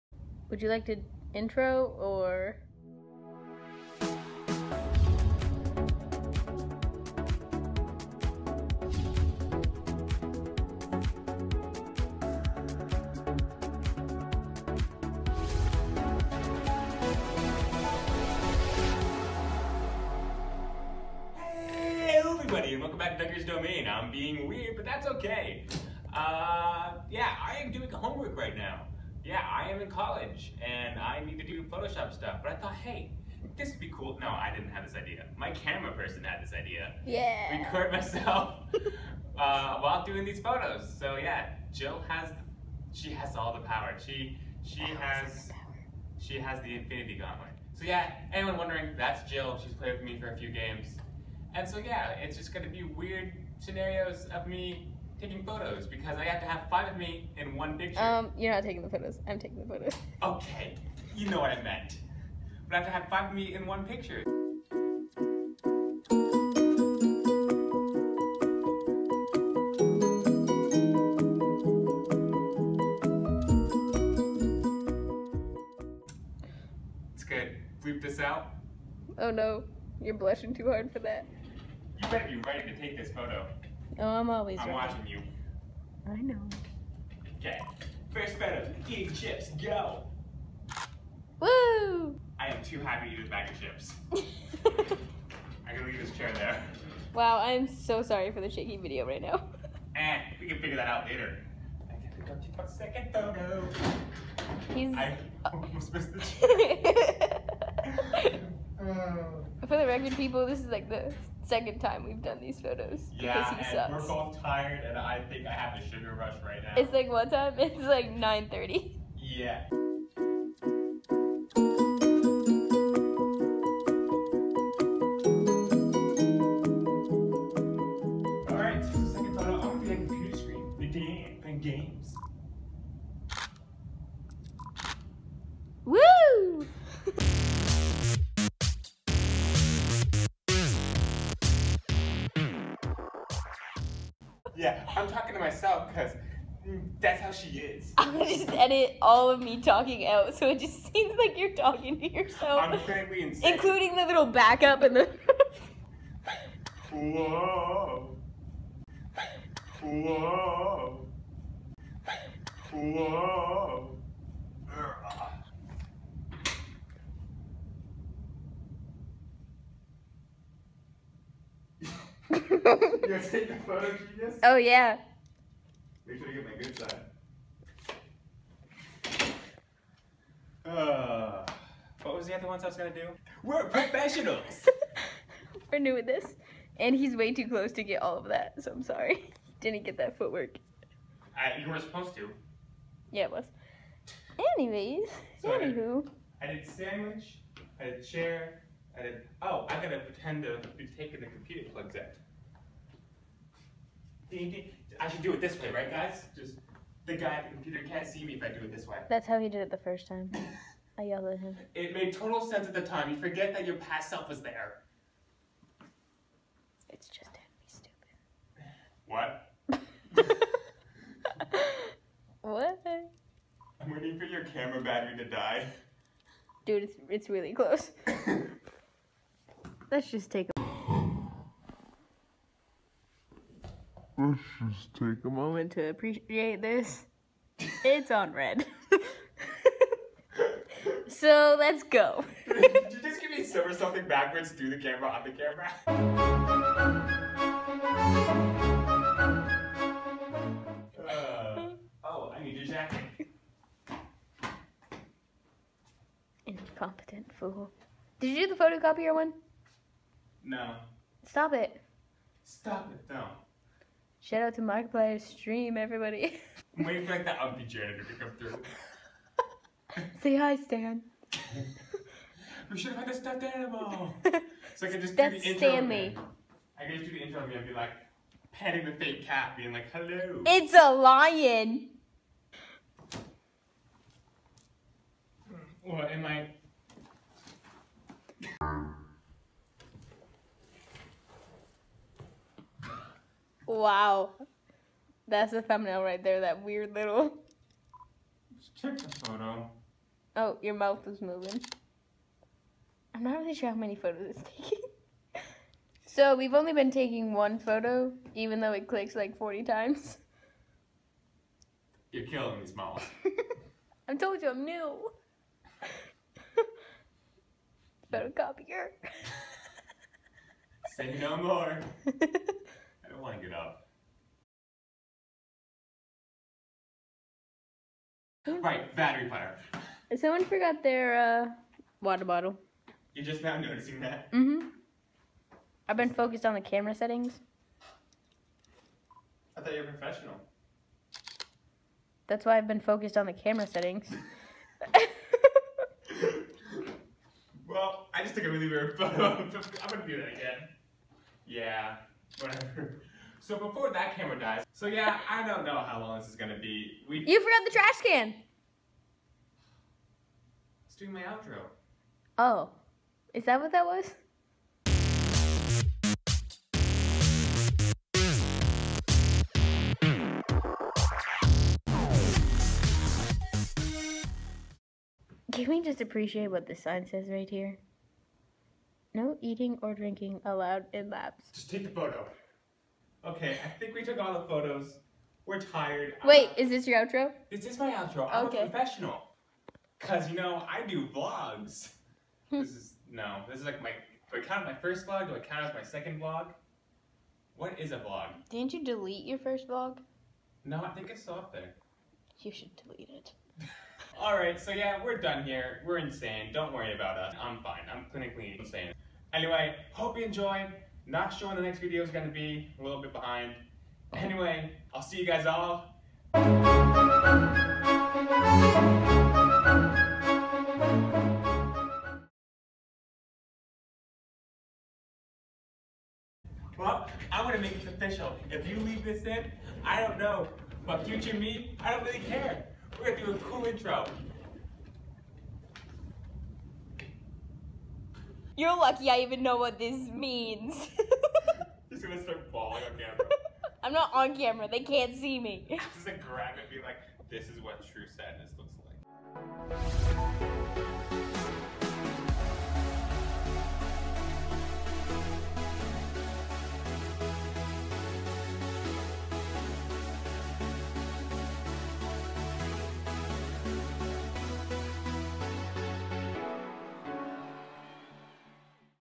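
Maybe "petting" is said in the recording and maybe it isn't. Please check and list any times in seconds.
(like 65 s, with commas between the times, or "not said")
278 s.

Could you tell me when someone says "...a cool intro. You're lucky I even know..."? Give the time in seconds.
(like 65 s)
433 s.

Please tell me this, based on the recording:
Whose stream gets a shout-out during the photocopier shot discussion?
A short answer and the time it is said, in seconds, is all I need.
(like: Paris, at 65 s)
Markiplier, at 264 s.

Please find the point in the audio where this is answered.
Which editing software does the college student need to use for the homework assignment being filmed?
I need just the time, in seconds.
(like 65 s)
31 s.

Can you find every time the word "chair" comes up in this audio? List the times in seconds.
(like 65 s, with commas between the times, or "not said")
96 s, 106 s, 198 s.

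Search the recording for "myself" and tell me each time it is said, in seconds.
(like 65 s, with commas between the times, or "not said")
37 s, 145 s.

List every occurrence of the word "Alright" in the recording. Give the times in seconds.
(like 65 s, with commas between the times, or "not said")
404 s.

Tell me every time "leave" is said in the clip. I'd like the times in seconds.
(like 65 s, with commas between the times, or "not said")
95 s, 428 s.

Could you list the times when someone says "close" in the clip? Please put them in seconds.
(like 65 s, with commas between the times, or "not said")
187 s, 227 s.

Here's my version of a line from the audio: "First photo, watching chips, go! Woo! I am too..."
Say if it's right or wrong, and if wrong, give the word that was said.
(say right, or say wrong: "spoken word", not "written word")
wrong: "eating", not "watching".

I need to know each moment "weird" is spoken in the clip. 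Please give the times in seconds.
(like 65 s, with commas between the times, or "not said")
24 s, 52 s, 296 s, 348 s.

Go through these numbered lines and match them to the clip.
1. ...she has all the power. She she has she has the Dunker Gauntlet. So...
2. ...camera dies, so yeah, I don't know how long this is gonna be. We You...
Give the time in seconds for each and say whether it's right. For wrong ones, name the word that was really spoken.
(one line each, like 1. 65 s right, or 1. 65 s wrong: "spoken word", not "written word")
1. 42 s wrong: "Infinity", not "Dunker"
2. 354 s right.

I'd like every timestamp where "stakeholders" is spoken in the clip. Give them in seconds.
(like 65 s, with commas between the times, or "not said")
not said.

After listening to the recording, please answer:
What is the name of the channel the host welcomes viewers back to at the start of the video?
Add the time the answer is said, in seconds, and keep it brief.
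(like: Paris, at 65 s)
Dunker's Domain, at 23 s.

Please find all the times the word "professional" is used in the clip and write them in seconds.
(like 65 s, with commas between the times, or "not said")
183 s, 339 s, 388 s.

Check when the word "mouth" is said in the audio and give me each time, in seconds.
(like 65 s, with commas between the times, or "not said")
300 s, 312 s.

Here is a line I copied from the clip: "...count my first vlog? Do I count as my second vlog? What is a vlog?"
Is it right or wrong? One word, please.
right.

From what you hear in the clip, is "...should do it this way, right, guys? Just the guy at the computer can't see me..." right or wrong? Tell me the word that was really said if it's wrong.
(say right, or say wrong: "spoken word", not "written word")
right.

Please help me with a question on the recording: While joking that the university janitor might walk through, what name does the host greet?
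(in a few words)
Stan.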